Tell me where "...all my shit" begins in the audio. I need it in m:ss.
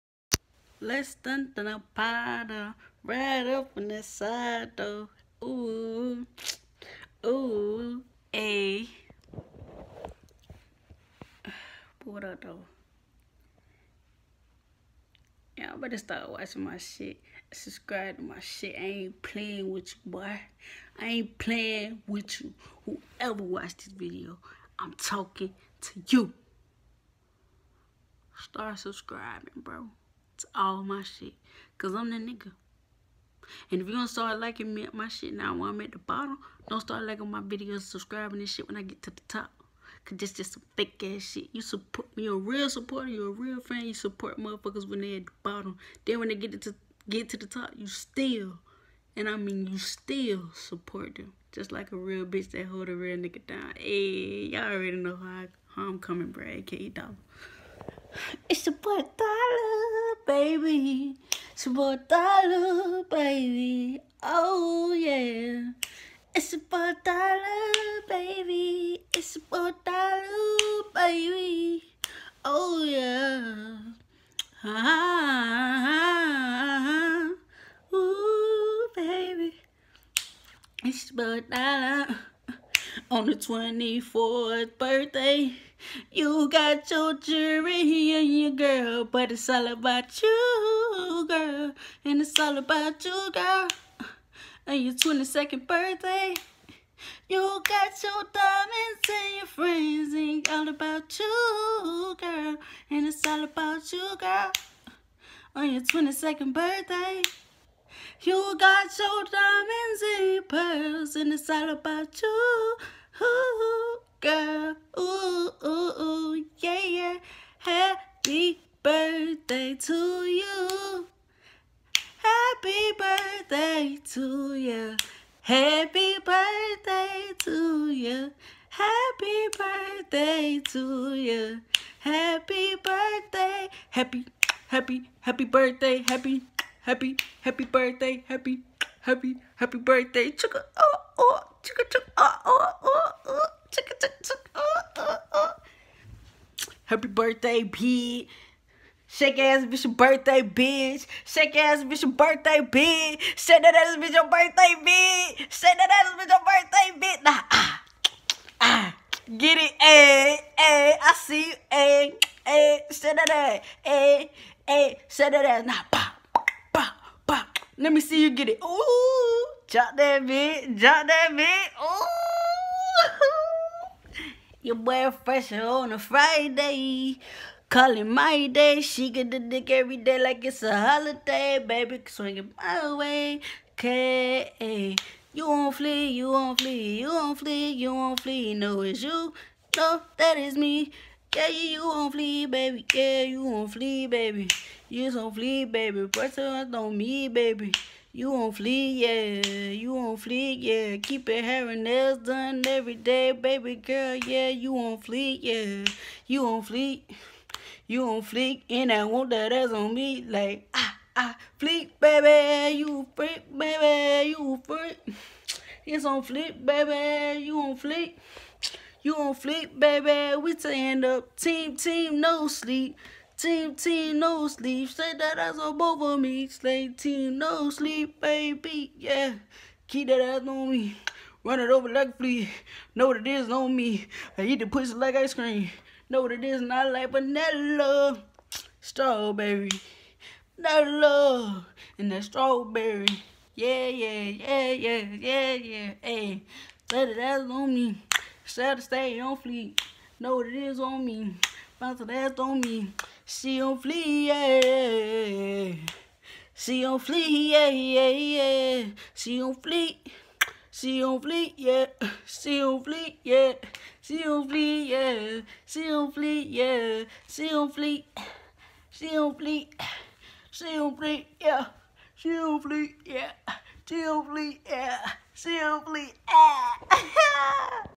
0:30.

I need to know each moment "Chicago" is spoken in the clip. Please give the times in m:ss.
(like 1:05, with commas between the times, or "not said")
not said.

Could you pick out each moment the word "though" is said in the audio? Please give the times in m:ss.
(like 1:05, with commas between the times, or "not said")
0:04, 0:12.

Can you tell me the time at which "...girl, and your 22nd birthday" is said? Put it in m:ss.
1:33.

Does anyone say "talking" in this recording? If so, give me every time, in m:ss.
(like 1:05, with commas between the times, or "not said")
0:24.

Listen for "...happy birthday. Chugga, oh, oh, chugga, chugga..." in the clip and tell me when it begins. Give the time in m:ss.
2:19.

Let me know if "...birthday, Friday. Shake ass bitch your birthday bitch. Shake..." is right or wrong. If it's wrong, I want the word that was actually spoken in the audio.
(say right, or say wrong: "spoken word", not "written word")
wrong: "Pete", not "Friday".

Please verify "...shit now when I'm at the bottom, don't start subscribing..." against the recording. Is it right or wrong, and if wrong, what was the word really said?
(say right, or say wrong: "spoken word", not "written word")
wrong: "liking", not "subscribing".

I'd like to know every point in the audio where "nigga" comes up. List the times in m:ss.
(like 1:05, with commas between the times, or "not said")
0:32, 0:53.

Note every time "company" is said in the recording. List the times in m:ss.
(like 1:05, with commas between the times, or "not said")
not said.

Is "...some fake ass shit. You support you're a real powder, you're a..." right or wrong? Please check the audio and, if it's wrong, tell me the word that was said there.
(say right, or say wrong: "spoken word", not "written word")
wrong: "supporter", not "powder".